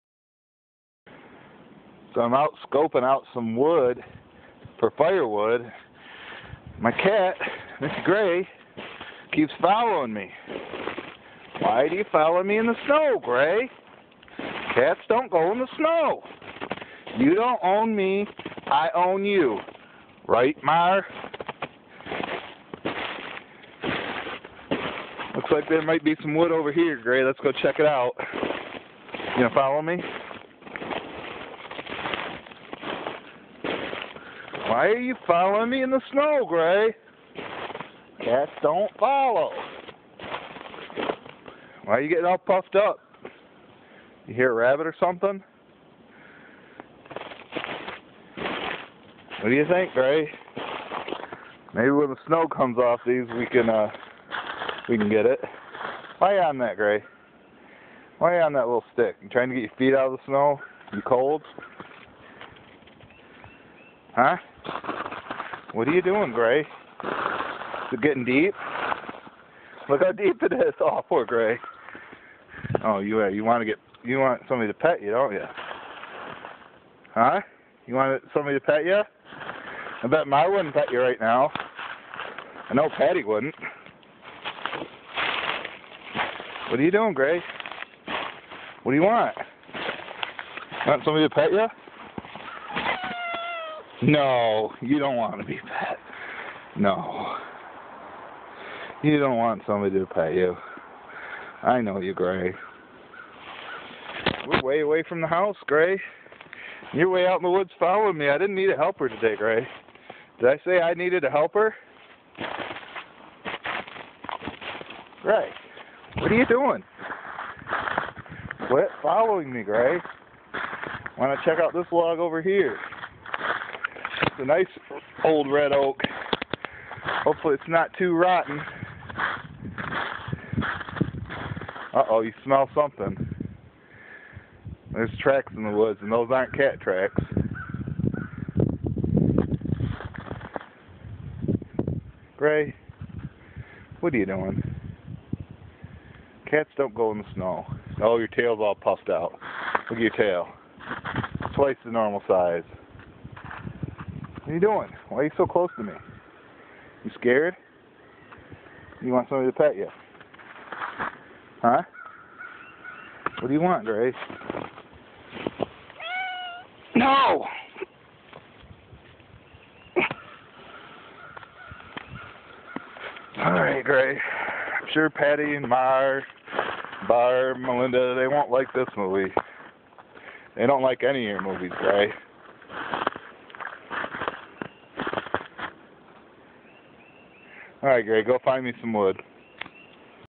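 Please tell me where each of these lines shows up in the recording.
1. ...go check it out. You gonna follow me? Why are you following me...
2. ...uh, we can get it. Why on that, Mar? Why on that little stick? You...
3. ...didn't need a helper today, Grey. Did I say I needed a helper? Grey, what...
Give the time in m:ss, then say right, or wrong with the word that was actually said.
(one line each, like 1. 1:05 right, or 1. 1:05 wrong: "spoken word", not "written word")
1. 0:27 right
2. 0:53 wrong: "Grey", not "Mar"
3. 1:48 right.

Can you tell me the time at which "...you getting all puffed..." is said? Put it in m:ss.
0:42.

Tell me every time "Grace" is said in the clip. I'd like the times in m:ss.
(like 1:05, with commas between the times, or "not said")
2:43, 2:53, 3:01.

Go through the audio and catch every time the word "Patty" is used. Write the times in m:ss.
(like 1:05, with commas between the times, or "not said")
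1:22, 2:55.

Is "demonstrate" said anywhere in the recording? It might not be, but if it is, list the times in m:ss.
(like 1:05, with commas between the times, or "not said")
not said.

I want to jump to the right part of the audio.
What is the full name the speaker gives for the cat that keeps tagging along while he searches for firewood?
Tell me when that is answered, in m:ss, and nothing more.
0:07.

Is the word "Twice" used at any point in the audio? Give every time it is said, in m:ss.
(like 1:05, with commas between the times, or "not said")
2:31.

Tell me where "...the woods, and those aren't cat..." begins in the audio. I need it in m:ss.
2:15.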